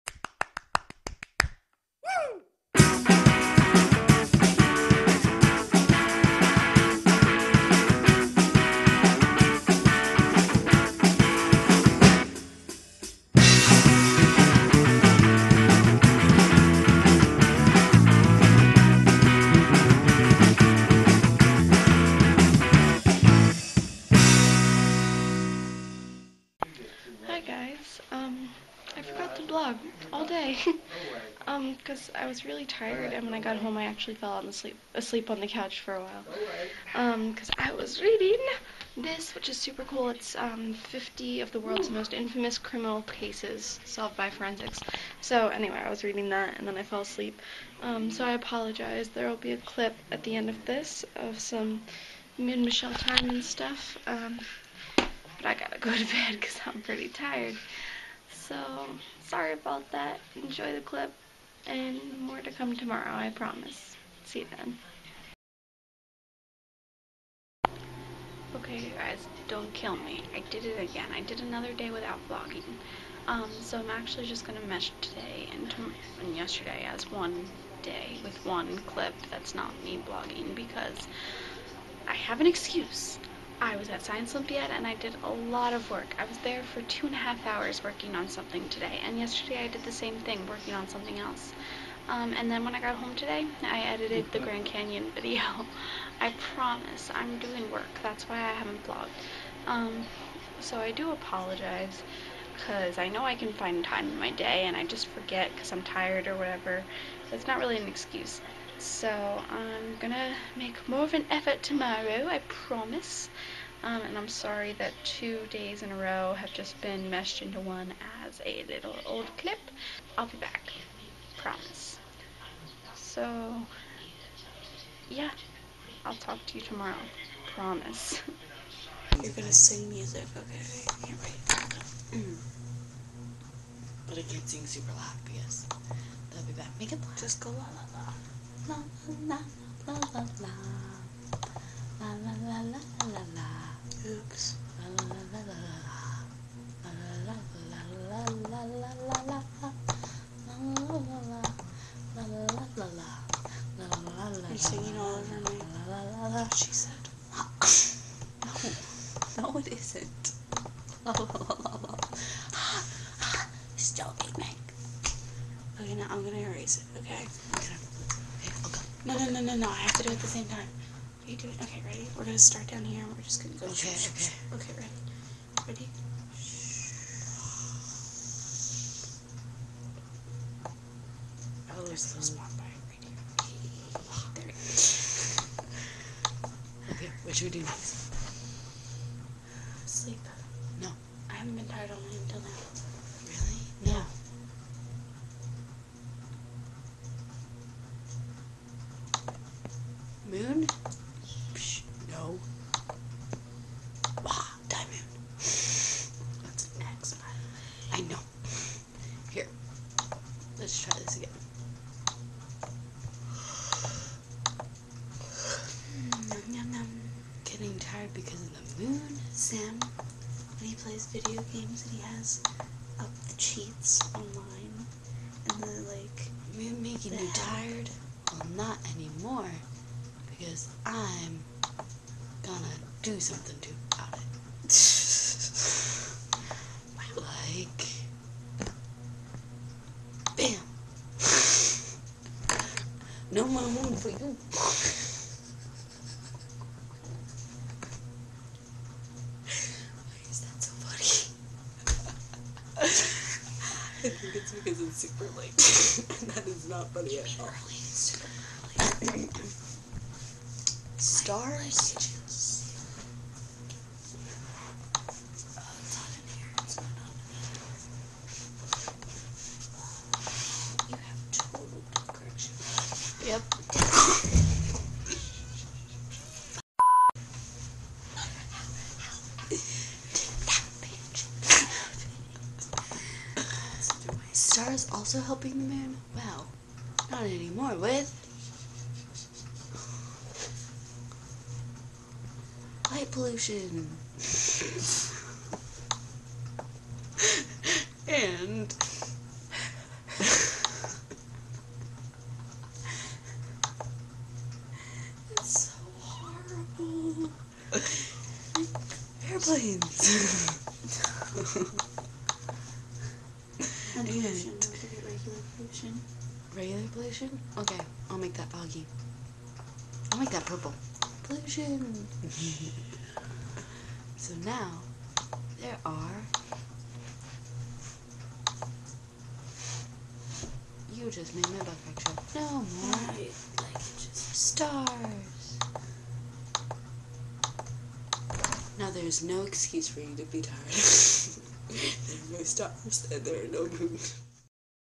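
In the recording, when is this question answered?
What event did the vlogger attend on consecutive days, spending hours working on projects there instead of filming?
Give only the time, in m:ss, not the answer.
1:24.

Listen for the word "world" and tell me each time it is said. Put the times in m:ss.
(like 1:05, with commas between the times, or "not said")
0:41.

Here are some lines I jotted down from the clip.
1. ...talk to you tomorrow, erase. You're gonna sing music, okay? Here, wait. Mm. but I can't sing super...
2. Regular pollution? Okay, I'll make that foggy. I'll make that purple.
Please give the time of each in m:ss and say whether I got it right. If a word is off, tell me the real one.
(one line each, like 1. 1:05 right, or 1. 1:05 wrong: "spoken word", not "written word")
1. 2:06 wrong: "promise", not "erase"
2. 5:16 right.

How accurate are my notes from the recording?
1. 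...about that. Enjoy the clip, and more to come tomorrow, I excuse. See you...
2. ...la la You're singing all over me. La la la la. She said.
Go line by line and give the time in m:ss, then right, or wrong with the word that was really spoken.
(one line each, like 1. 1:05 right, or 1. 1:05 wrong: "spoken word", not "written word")
1. 0:59 wrong: "promise", not "excuse"
2. 2:32 right.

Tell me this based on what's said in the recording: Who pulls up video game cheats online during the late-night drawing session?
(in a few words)
Sam.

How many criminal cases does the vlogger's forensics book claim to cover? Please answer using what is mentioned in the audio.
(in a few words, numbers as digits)
50.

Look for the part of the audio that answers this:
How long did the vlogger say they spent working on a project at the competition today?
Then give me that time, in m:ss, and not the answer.
1:26.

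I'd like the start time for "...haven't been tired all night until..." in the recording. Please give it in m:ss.
3:11.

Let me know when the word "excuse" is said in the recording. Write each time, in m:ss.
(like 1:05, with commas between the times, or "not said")
1:22, 1:47, 5:39.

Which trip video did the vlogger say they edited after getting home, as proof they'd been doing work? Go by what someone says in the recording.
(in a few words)
Grand Canyon.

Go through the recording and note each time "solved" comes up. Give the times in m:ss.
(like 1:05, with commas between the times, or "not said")
0:43.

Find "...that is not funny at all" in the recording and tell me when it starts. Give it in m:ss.
4:16.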